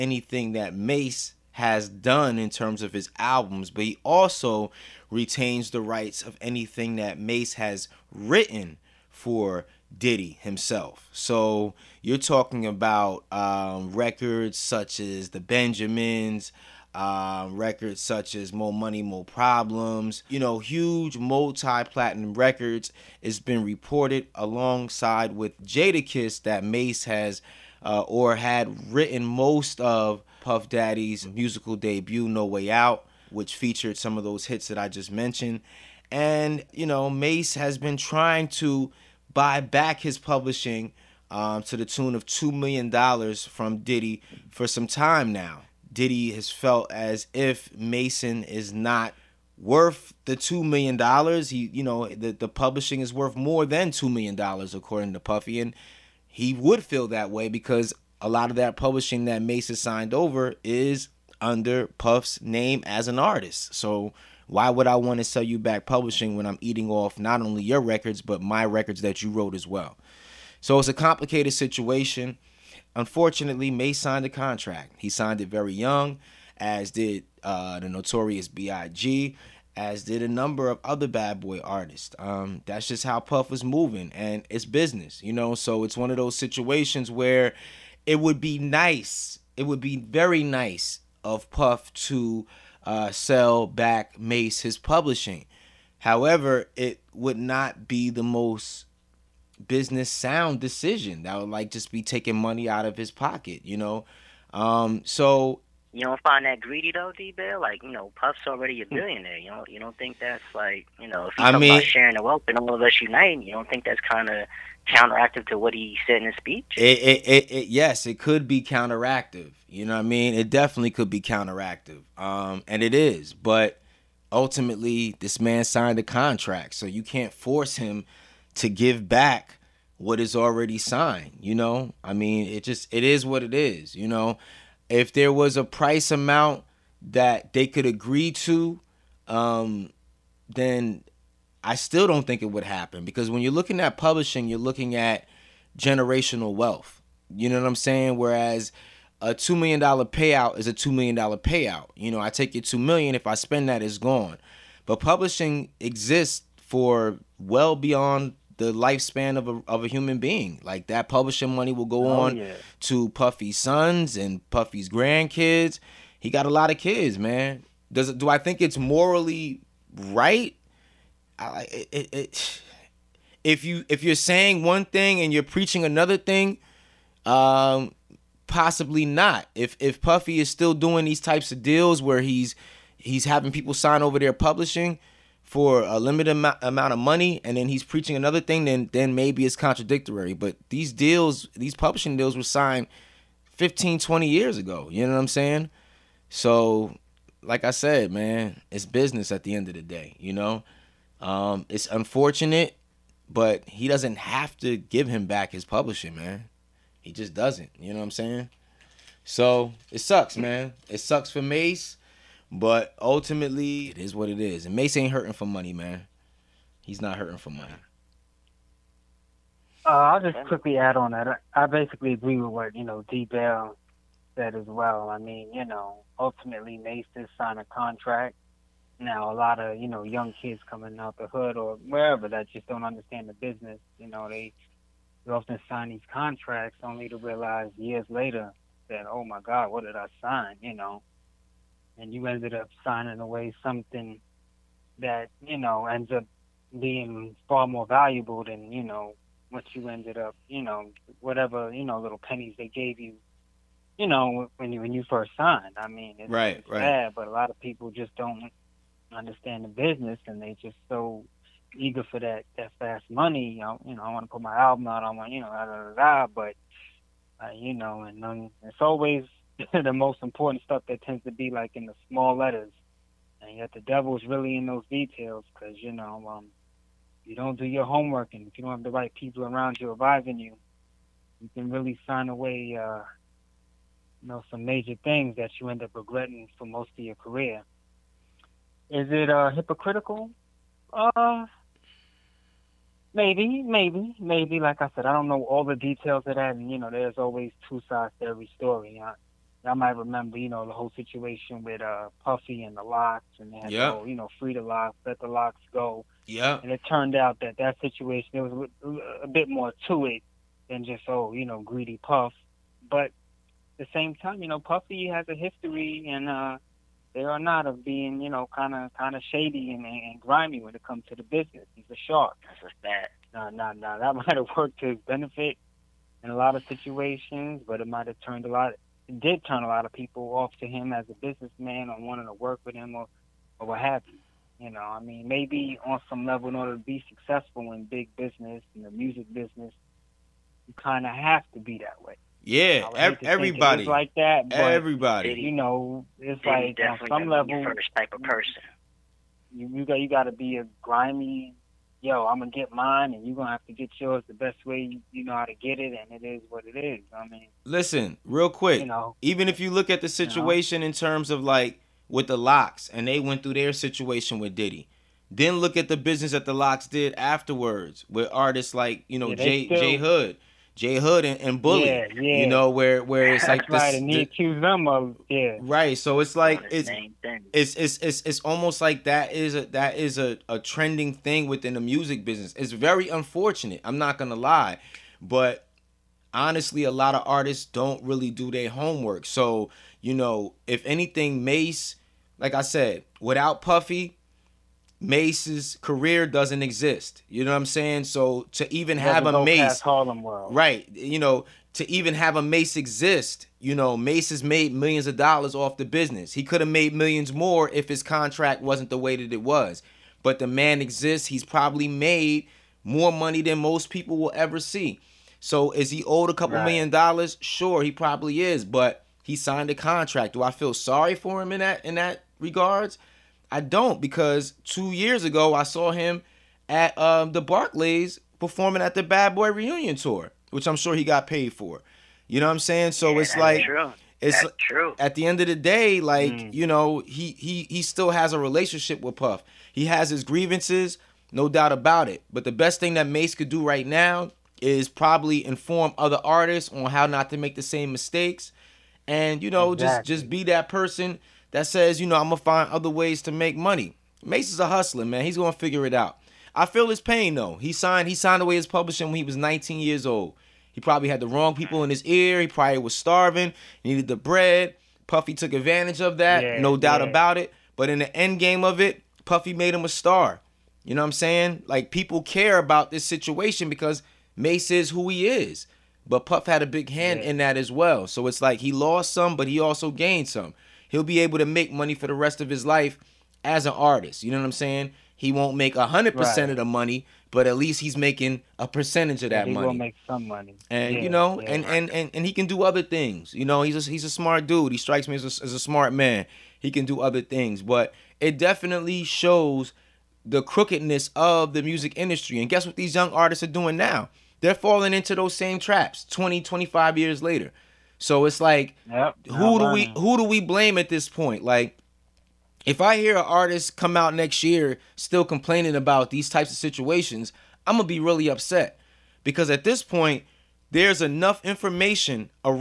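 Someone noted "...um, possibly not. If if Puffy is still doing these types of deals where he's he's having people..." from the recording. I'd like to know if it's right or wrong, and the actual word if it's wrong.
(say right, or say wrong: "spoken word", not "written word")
right.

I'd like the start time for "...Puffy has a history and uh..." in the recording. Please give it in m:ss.
5:14.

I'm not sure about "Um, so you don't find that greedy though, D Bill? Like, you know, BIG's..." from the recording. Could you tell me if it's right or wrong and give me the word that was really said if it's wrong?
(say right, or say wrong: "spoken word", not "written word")
wrong: "Puff", not "BIG".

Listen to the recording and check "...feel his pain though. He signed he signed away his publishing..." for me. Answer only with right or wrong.
right.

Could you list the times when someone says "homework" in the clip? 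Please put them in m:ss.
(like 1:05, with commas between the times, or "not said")
4:37, 6:28.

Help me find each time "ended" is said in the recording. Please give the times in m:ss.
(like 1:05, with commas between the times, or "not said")
4:02, 4:09.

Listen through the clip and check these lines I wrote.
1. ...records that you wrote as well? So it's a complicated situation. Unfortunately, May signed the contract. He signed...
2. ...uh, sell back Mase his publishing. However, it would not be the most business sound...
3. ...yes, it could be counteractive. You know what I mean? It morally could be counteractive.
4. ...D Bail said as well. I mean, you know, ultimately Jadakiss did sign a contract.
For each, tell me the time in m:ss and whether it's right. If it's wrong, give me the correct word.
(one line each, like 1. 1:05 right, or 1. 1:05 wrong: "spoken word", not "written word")
1. 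1:08 right
2. 1:32 right
3. 1:57 wrong: "definitely", not "morally"
4. 3:43 wrong: "Mase", not "Jadakiss".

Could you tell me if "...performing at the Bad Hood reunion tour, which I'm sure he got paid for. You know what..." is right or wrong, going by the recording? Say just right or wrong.
wrong.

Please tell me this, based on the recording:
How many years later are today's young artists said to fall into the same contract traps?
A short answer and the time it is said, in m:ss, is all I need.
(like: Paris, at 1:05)
20, 25 years, at 8:26.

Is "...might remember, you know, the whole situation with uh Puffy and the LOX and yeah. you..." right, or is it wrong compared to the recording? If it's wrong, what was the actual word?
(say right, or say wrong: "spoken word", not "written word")
right.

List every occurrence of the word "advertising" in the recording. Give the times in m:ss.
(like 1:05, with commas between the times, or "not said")
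not said.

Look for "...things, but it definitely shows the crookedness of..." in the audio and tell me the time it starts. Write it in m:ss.
8:17.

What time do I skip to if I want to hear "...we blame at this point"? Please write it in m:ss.
8:30.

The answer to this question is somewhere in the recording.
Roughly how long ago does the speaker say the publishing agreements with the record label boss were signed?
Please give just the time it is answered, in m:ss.
3:13.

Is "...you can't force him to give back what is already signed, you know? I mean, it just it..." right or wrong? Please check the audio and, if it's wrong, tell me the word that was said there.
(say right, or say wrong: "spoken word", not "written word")
right.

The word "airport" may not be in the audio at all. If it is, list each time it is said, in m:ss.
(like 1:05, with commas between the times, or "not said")
not said.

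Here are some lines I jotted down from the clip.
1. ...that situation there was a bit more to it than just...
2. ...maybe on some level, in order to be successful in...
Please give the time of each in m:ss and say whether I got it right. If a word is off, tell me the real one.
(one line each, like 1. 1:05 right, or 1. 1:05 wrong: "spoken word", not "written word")
1. 5:07 right
2. 5:35 right.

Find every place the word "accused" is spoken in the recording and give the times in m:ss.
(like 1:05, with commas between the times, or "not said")
6:14.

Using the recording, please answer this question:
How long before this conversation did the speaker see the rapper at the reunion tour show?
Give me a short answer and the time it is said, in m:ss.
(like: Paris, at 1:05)
2 years, at 7:04.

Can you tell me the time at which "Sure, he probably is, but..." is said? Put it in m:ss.
6:57.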